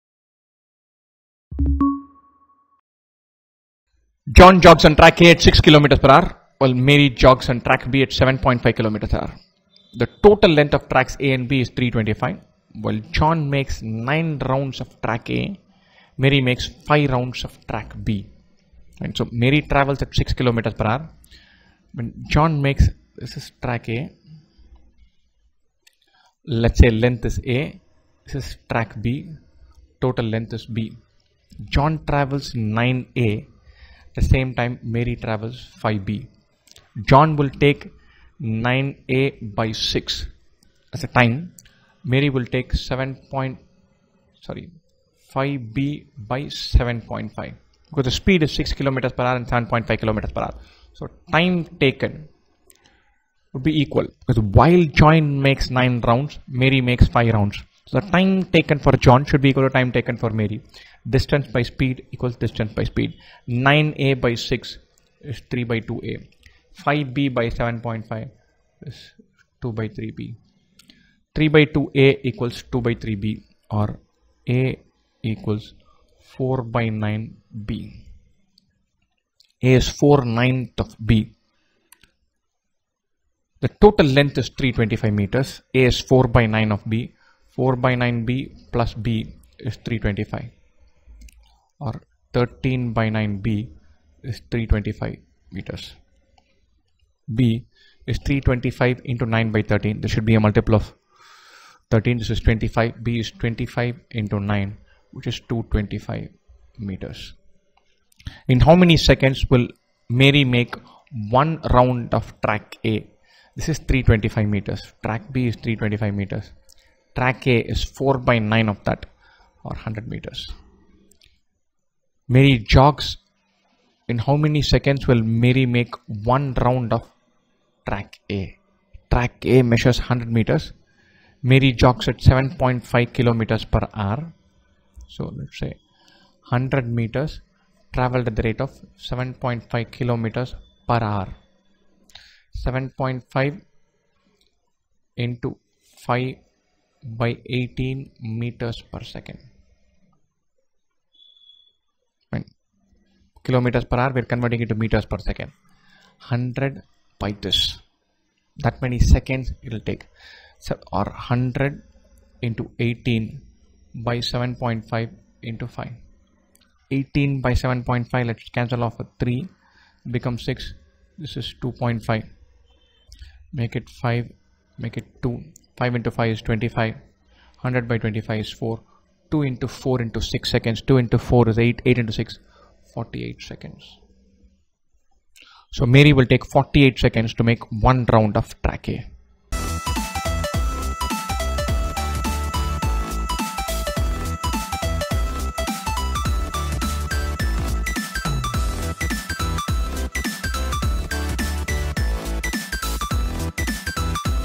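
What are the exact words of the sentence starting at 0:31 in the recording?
John travels 9A the same time Mary travels 5b.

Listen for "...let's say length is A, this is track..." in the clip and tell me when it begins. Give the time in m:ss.
0:26.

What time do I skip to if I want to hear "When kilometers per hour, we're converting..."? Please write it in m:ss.
2:32.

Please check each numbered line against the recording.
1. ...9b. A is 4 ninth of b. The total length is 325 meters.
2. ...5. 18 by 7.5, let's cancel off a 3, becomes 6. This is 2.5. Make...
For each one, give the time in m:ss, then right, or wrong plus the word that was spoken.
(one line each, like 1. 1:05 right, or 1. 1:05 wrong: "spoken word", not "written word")
1. 1:16 right
2. 2:45 right.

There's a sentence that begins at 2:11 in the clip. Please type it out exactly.
Mary jogs at 7.5 kilometers per hour.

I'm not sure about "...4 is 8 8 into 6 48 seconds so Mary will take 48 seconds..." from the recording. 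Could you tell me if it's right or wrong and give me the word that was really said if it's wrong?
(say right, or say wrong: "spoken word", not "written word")
right.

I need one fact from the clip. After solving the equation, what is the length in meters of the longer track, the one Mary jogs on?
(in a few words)
225 meters.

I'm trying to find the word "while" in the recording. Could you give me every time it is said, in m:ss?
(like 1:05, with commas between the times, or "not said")
0:06, 0:12, 0:54.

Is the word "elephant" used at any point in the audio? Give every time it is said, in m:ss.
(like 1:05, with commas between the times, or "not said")
not said.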